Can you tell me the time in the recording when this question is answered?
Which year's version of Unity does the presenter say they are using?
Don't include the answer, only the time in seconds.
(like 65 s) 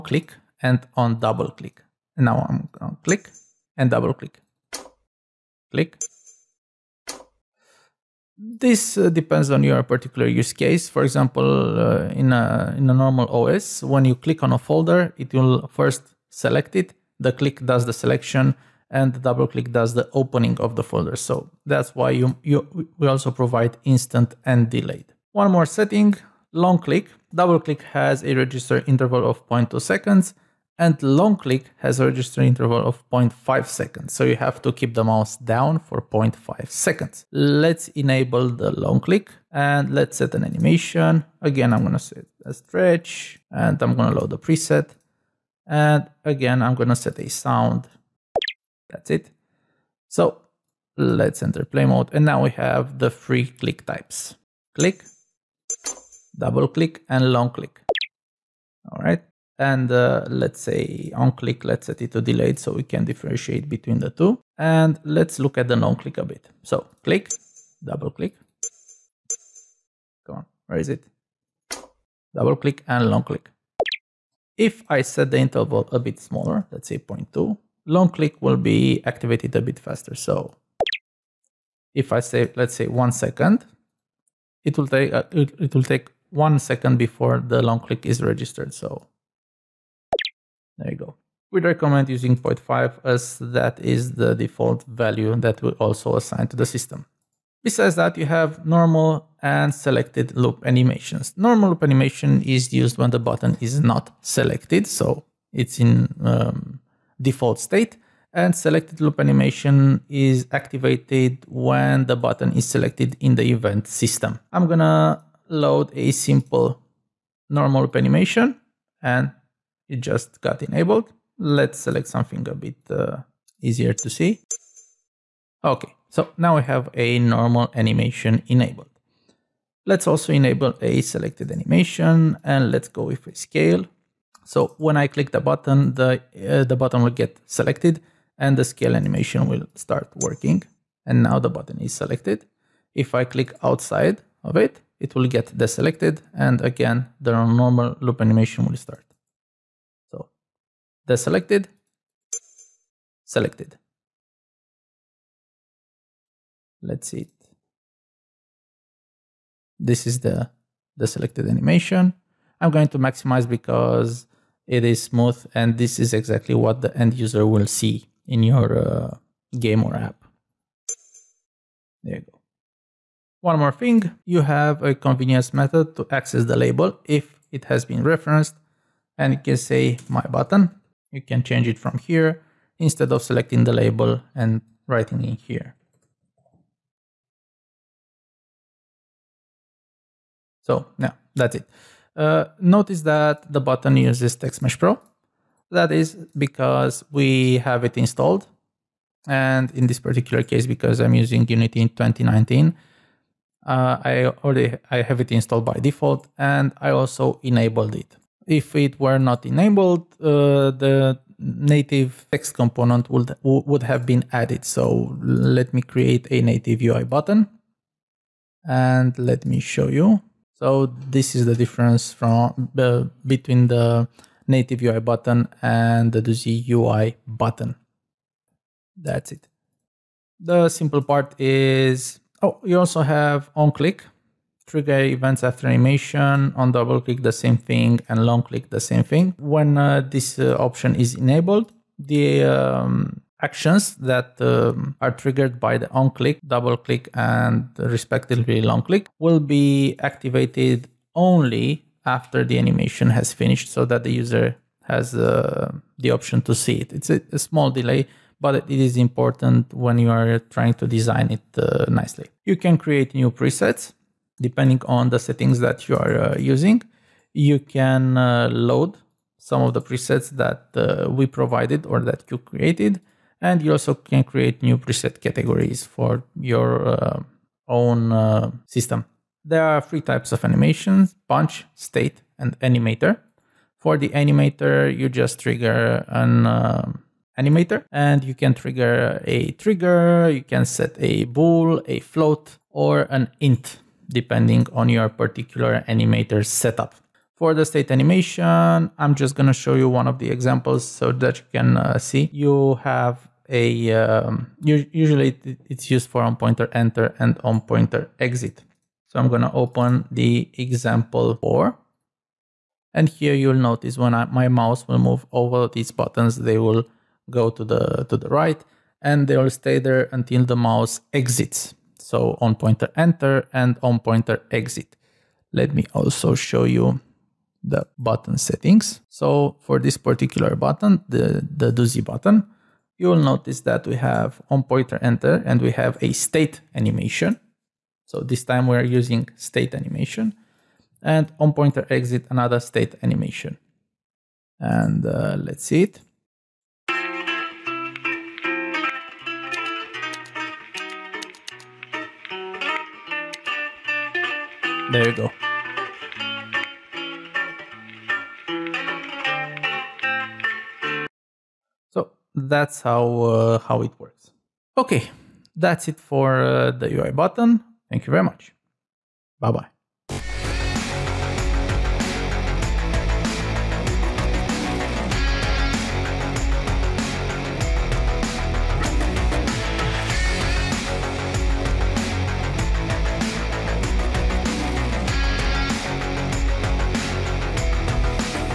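201 s.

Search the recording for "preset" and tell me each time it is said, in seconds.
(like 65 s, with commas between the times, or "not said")
44 s, 263 s, 269 s, 274 s.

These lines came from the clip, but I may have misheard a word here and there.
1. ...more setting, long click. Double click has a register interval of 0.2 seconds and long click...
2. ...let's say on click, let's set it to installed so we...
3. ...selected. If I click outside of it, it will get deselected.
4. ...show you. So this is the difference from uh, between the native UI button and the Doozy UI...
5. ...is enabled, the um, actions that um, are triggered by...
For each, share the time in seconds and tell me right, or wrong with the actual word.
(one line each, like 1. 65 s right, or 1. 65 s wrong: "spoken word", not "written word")
1. 25 s right
2. 60 s wrong: "delayed", not "installed"
3. 141 s right
4. 219 s right
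5. 240 s right.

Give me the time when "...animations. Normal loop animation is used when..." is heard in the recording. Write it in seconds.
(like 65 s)
100 s.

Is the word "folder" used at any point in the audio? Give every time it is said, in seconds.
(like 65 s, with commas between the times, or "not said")
14 s, 20 s.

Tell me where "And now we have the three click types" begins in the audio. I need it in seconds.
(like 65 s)
52 s.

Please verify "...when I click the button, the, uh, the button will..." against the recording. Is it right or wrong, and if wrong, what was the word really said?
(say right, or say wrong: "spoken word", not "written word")
right.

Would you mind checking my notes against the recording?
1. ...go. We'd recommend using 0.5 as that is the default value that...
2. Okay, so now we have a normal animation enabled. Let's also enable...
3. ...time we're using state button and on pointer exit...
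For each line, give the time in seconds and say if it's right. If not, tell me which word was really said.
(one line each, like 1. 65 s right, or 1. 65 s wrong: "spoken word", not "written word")
1. 90 s right
2. 125 s right
3. 338 s wrong: "animation", not "button".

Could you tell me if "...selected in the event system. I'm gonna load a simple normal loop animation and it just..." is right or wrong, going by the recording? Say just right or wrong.
right.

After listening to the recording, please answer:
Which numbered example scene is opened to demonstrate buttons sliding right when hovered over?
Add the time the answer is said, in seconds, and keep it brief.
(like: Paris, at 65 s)
example 4, at 310 s.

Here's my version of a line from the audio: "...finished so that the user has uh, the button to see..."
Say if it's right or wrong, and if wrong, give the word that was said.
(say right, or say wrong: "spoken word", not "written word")
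wrong: "option", not "button".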